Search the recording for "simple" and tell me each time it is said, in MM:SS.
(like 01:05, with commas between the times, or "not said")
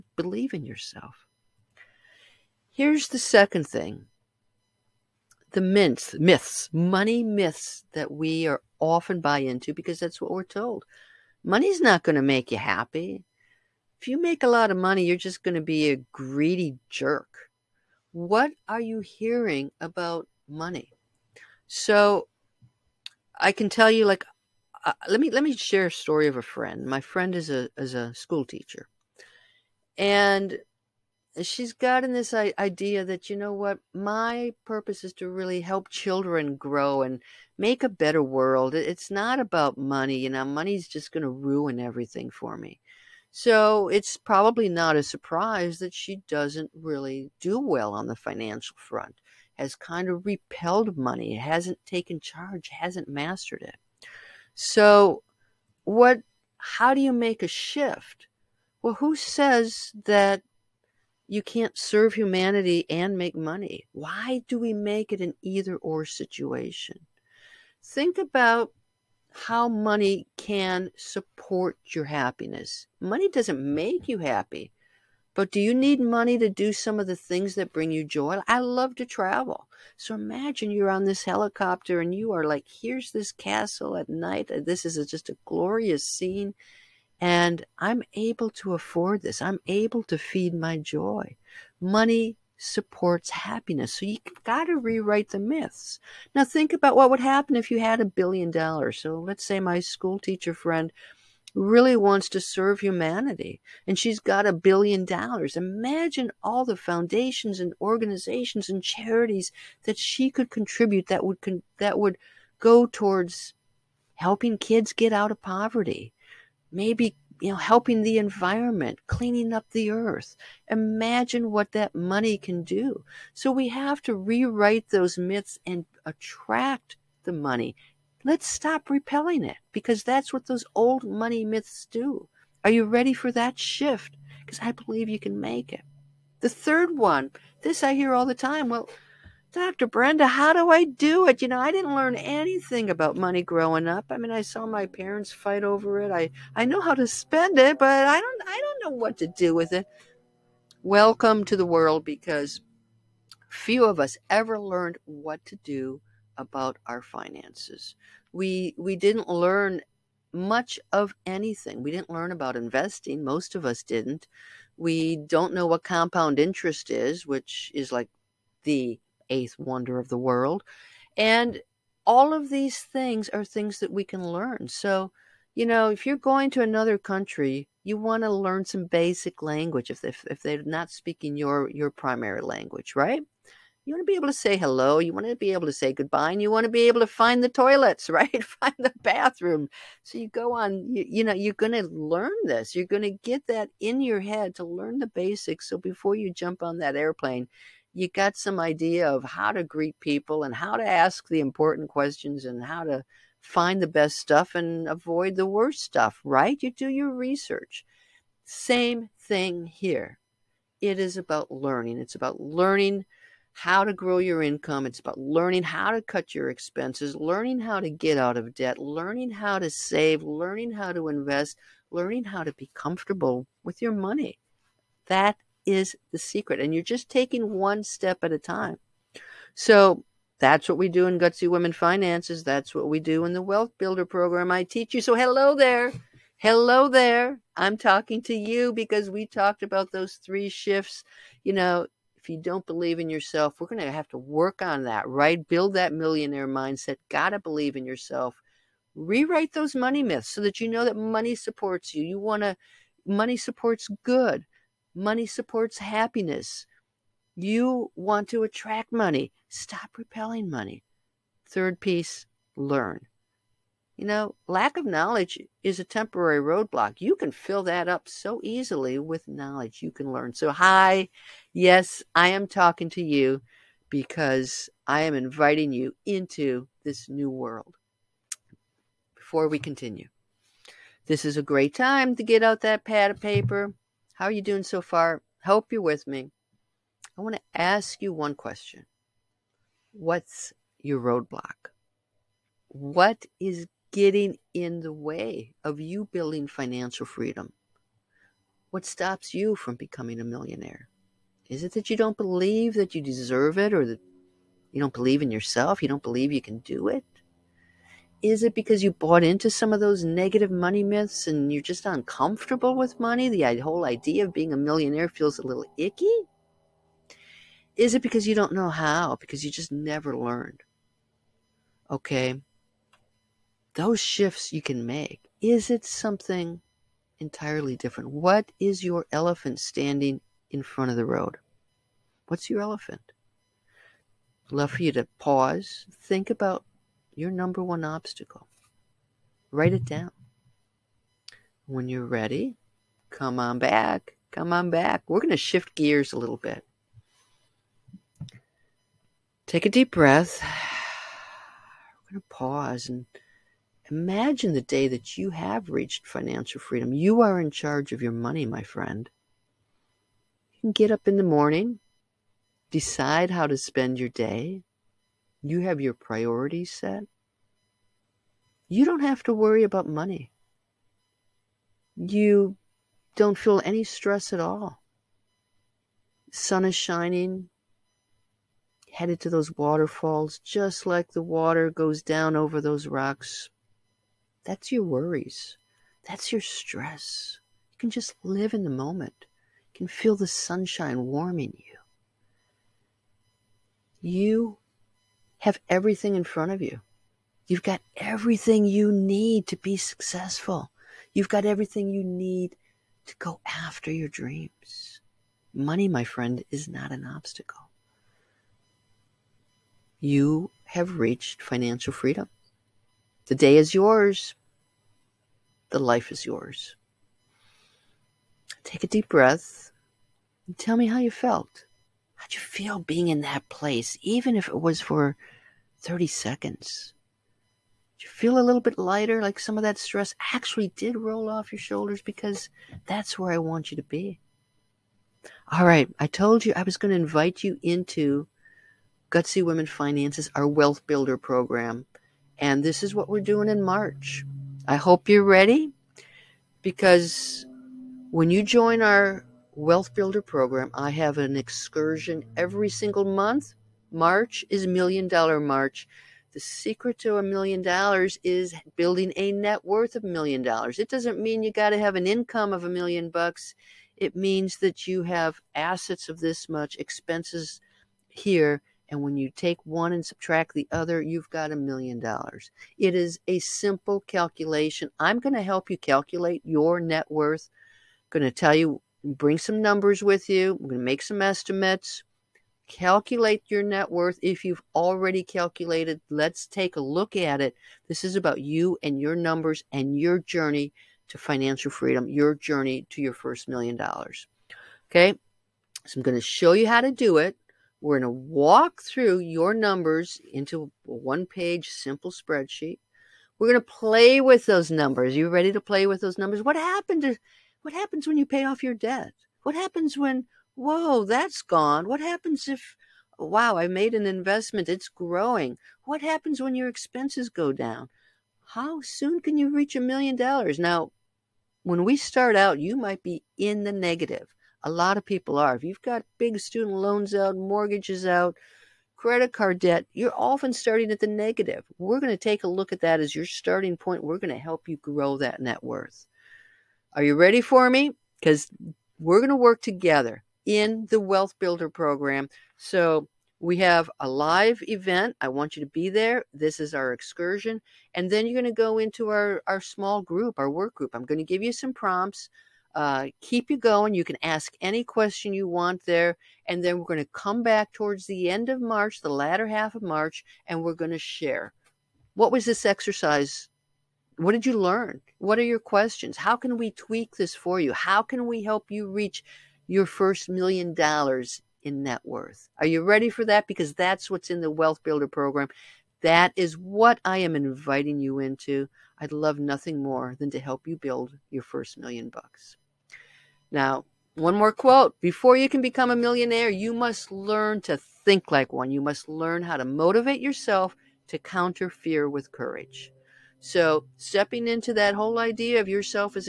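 07:53, 08:21.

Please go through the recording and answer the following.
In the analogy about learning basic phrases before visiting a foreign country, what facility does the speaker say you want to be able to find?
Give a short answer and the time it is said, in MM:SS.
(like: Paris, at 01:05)
The toilets, at 03:07.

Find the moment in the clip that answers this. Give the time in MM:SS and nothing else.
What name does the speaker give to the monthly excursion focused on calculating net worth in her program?
07:34.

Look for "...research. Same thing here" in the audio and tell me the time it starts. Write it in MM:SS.
03:27.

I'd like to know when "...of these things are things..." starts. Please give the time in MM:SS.
02:52.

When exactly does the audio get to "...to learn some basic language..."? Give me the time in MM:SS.
02:58.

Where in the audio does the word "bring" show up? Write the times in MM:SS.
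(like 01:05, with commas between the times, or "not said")
01:17, 07:59.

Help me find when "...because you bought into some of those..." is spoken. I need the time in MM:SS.
05:08.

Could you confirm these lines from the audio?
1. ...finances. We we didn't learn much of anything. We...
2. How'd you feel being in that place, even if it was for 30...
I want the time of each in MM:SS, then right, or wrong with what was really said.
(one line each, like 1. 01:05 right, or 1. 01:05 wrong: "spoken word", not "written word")
1. 02:37 right
2. 07:02 right.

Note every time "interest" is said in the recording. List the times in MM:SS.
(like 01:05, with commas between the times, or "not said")
02:46.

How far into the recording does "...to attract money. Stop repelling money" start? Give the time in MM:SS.
04:18.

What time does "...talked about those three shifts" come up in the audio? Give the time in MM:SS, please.
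03:59.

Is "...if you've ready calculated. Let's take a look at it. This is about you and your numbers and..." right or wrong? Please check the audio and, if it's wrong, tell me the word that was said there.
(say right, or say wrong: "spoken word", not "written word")
wrong: "already", not "ready".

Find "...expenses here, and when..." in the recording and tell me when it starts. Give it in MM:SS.
07:46.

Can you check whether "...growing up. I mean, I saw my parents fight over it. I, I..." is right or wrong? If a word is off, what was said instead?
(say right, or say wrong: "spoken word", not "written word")
right.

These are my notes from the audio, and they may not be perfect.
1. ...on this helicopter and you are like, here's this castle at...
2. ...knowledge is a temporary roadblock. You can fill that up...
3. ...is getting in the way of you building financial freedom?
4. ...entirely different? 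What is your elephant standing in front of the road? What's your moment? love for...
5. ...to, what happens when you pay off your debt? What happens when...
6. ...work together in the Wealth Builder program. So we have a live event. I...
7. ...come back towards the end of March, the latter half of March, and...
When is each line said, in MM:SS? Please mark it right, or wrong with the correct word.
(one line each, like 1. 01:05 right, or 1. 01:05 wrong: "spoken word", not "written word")
1. 01:20 right
2. 04:24 right
3. 04:53 right
4. 05:27 wrong: "elephant", not "moment"
5. 08:27 right
6. 08:59 right
7. 09:17 right.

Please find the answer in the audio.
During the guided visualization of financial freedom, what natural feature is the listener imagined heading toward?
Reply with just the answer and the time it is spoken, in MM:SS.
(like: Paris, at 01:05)
Waterfalls, at 06:19.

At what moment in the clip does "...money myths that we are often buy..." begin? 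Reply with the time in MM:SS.
00:06.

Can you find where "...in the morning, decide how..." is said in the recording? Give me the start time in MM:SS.
06:01.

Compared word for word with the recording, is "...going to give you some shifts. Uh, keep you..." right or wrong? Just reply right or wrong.
wrong.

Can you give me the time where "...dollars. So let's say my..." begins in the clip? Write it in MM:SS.
01:38.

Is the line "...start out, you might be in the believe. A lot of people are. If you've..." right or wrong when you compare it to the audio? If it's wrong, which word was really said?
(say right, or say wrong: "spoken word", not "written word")
wrong: "negative", not "believe".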